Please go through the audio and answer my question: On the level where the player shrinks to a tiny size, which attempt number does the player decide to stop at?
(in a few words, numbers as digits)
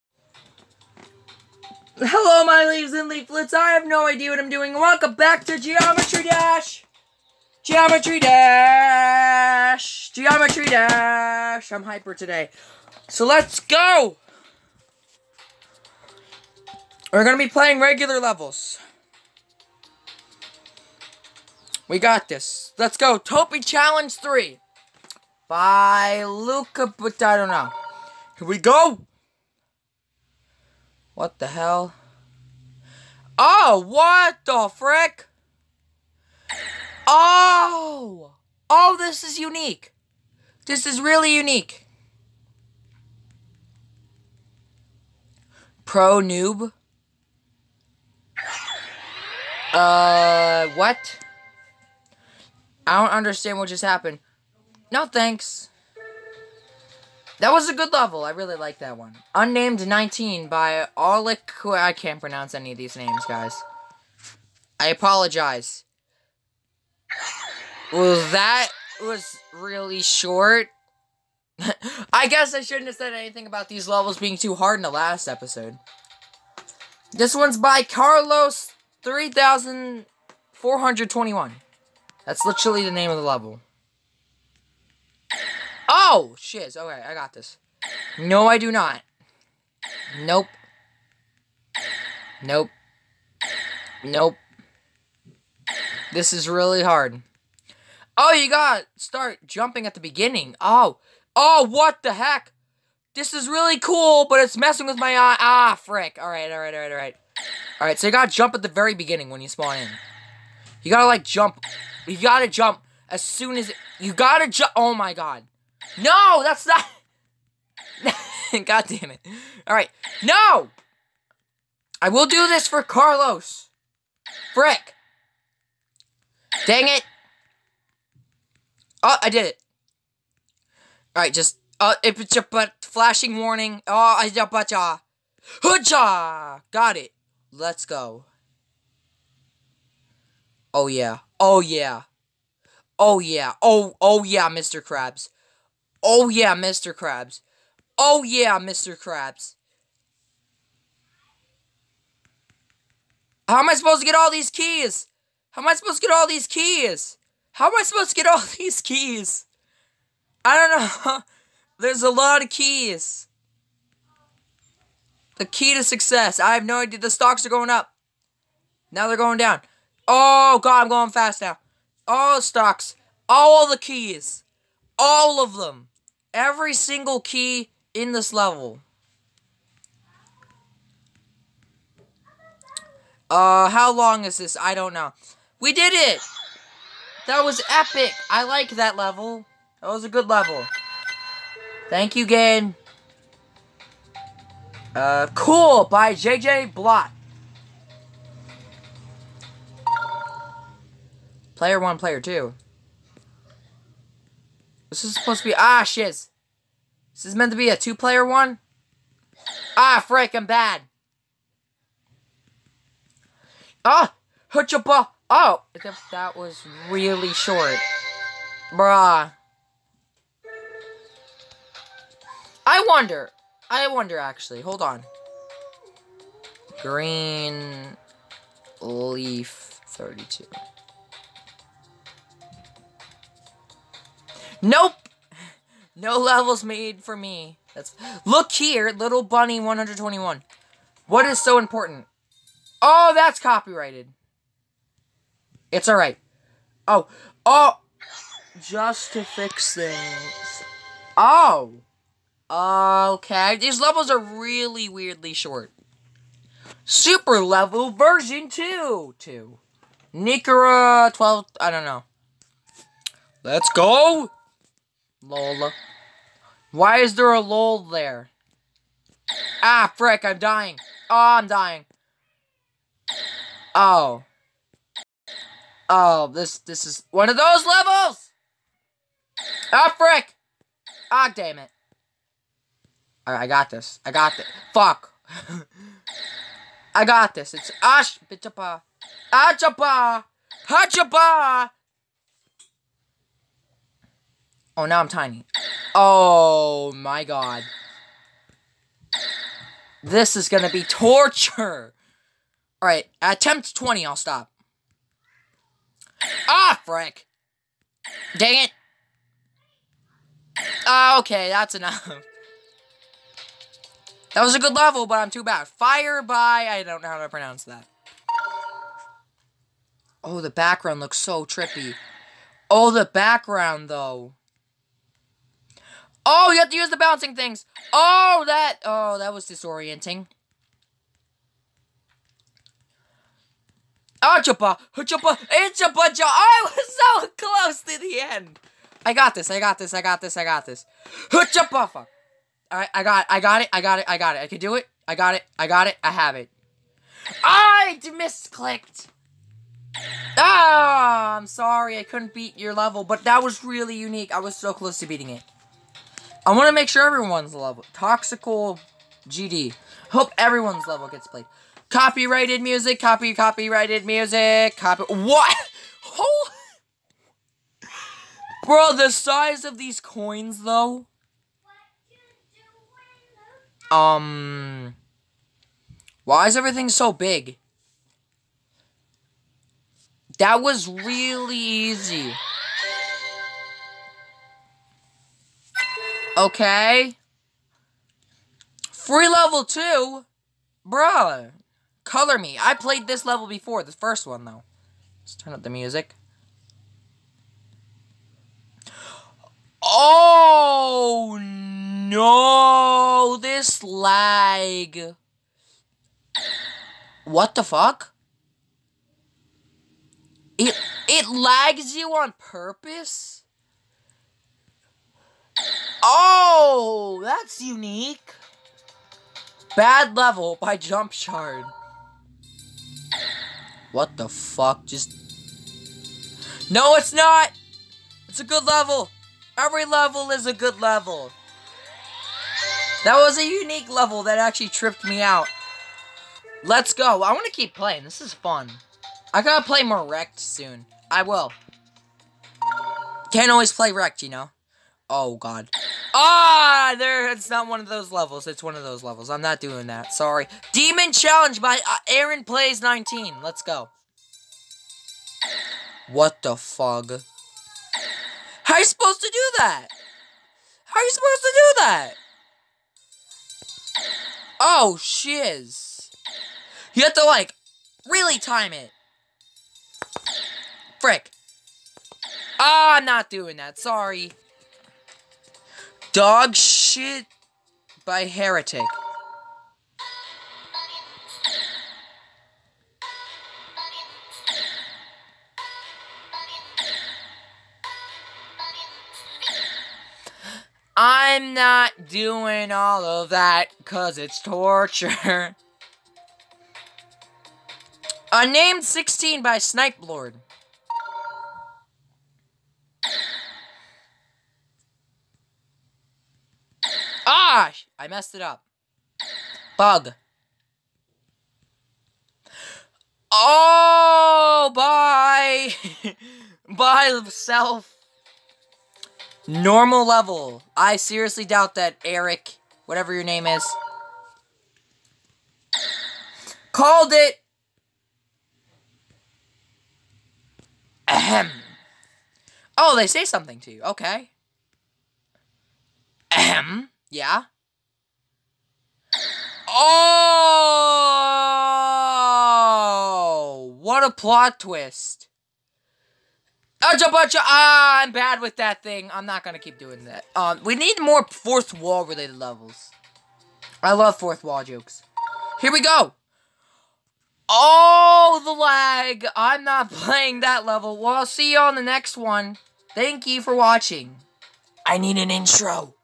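20.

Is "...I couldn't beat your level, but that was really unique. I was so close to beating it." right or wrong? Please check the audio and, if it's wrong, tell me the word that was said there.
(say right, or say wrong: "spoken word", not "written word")
right.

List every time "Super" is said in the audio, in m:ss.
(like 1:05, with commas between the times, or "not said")
4:16.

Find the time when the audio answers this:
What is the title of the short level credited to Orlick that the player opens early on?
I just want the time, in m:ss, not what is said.
0:59.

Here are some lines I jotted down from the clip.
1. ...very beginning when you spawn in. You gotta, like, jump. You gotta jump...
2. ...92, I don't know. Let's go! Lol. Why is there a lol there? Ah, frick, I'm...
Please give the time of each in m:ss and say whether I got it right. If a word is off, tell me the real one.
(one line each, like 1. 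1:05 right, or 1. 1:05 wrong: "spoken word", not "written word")
1. 1:48 right
2. 4:21 wrong: "12", not "92".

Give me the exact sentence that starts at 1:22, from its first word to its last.
That's literally the name of the level.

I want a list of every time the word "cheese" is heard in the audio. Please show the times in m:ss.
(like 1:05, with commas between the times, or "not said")
not said.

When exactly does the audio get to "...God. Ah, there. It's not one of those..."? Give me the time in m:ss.
7:25.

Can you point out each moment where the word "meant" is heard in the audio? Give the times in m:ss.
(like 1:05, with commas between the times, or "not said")
3:27.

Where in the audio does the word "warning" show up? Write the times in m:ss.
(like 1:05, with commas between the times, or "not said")
2:13.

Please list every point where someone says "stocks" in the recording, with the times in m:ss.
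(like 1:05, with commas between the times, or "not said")
2:47, 2:52.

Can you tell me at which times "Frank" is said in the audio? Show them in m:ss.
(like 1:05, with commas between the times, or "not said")
3:30.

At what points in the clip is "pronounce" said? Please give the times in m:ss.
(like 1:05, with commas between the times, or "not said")
1:02, 5:17.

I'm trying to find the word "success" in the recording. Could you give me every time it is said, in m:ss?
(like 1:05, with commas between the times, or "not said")
2:45.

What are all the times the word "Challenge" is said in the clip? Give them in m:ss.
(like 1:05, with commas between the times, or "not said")
0:23, 7:31.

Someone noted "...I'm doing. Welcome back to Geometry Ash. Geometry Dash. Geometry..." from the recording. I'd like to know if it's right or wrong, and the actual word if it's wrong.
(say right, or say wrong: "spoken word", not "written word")
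wrong: "Dash", not "Ash".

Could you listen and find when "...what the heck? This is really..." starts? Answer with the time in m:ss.
1:41.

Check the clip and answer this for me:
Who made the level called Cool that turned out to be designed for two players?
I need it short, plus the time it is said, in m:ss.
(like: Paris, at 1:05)
JJ Blot, at 3:16.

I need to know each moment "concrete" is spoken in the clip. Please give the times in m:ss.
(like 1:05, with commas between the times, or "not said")
not said.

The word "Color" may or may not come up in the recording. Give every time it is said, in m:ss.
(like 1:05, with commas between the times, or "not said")
6:32.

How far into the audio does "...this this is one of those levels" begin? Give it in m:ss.
4:36.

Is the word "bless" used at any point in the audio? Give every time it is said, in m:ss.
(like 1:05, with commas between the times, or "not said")
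not said.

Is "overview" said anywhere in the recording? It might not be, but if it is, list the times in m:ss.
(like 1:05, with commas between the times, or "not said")
not said.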